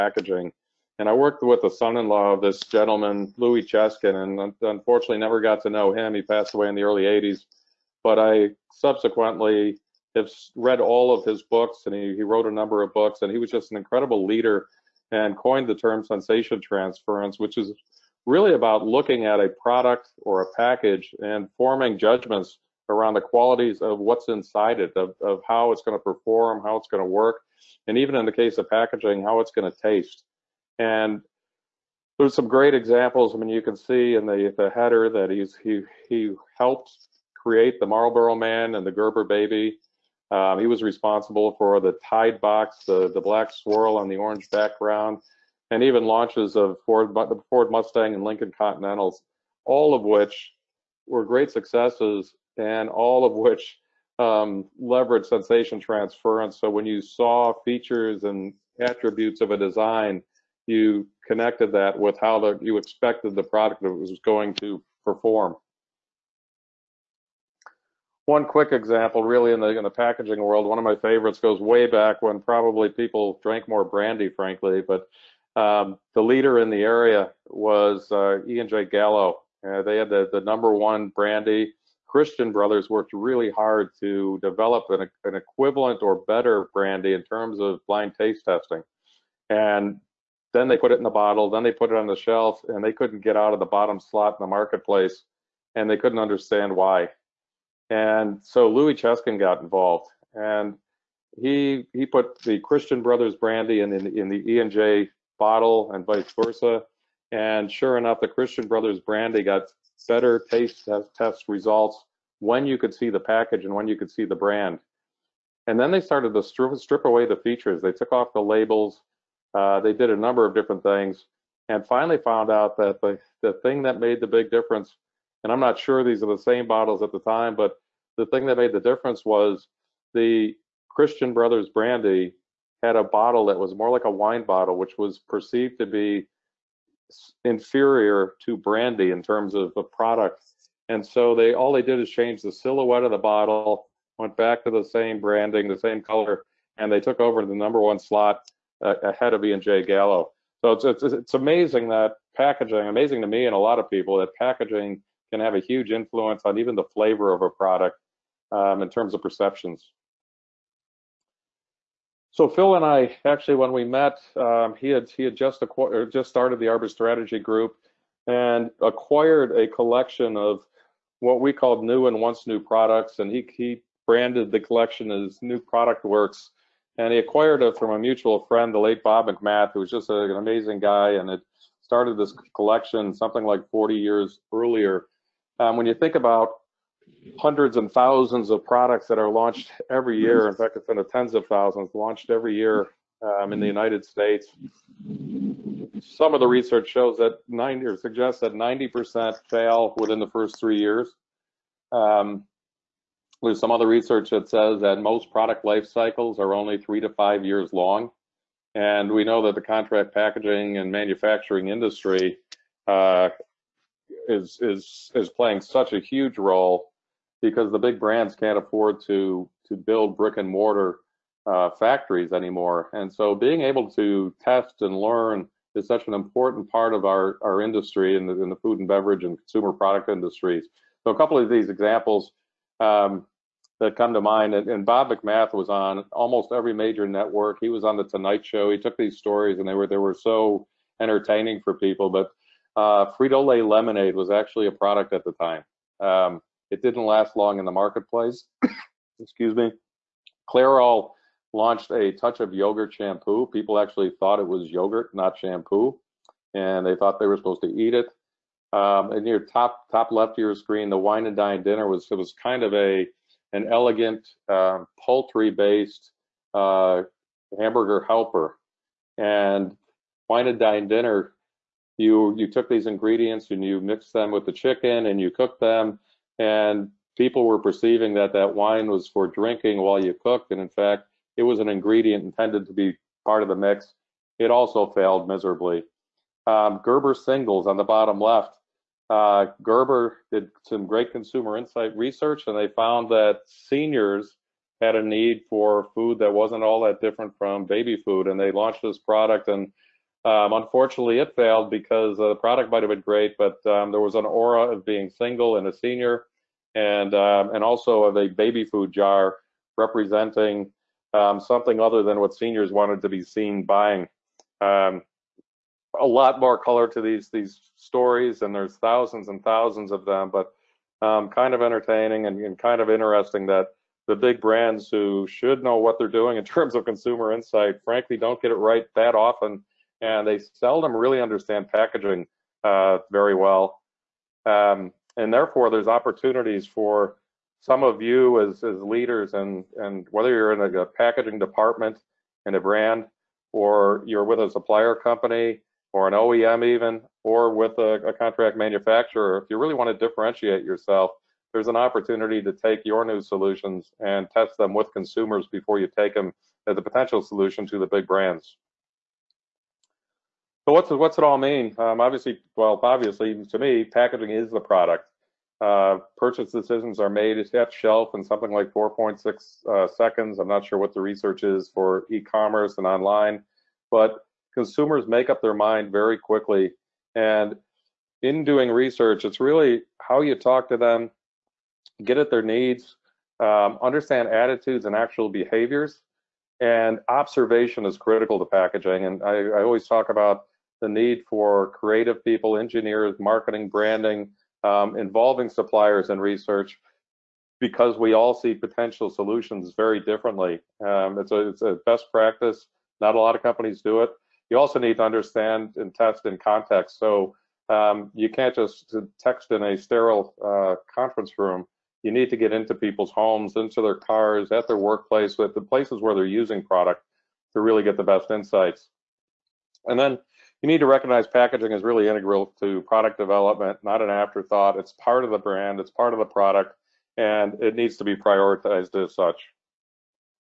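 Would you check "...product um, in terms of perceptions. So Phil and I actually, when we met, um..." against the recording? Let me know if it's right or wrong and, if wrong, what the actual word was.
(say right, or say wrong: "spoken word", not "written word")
right.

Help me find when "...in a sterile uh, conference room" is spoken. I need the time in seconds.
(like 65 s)
409 s.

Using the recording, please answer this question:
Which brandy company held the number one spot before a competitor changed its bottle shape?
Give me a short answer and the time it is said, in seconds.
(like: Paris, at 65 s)
E and J Gallo, at 78 s.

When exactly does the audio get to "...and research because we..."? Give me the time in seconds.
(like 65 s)
396 s.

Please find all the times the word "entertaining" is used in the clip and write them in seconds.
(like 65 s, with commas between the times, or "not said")
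240 s, 321 s.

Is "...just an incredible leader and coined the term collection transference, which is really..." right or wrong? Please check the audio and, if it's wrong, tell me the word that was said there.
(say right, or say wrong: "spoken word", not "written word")
wrong: "sensation", not "collection".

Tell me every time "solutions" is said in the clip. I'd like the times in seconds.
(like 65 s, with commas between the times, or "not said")
353 s, 357 s, 399 s.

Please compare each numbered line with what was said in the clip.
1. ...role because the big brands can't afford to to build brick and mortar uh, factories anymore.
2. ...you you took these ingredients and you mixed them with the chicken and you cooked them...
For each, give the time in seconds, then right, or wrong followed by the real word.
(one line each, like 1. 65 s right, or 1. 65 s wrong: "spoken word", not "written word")
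1. 216 s right
2. 271 s right.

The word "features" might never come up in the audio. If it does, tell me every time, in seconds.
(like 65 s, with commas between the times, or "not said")
57 s, 117 s.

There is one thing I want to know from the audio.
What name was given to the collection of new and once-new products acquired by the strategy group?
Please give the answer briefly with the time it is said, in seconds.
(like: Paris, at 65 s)
New Product Works, at 175 s.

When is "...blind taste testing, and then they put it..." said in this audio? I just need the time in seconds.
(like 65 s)
87 s.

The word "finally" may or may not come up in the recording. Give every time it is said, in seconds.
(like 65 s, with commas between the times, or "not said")
121 s.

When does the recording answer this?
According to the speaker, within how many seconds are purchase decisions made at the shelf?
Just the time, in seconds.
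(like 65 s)
368 s.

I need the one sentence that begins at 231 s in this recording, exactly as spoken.
So a couple of these examples um, that come to mind, and, and, Bob McMath was on almost every major network.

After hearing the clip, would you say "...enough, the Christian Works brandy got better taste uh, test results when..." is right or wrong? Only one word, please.
wrong.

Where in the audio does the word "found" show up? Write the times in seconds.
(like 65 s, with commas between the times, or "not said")
122 s, 292 s.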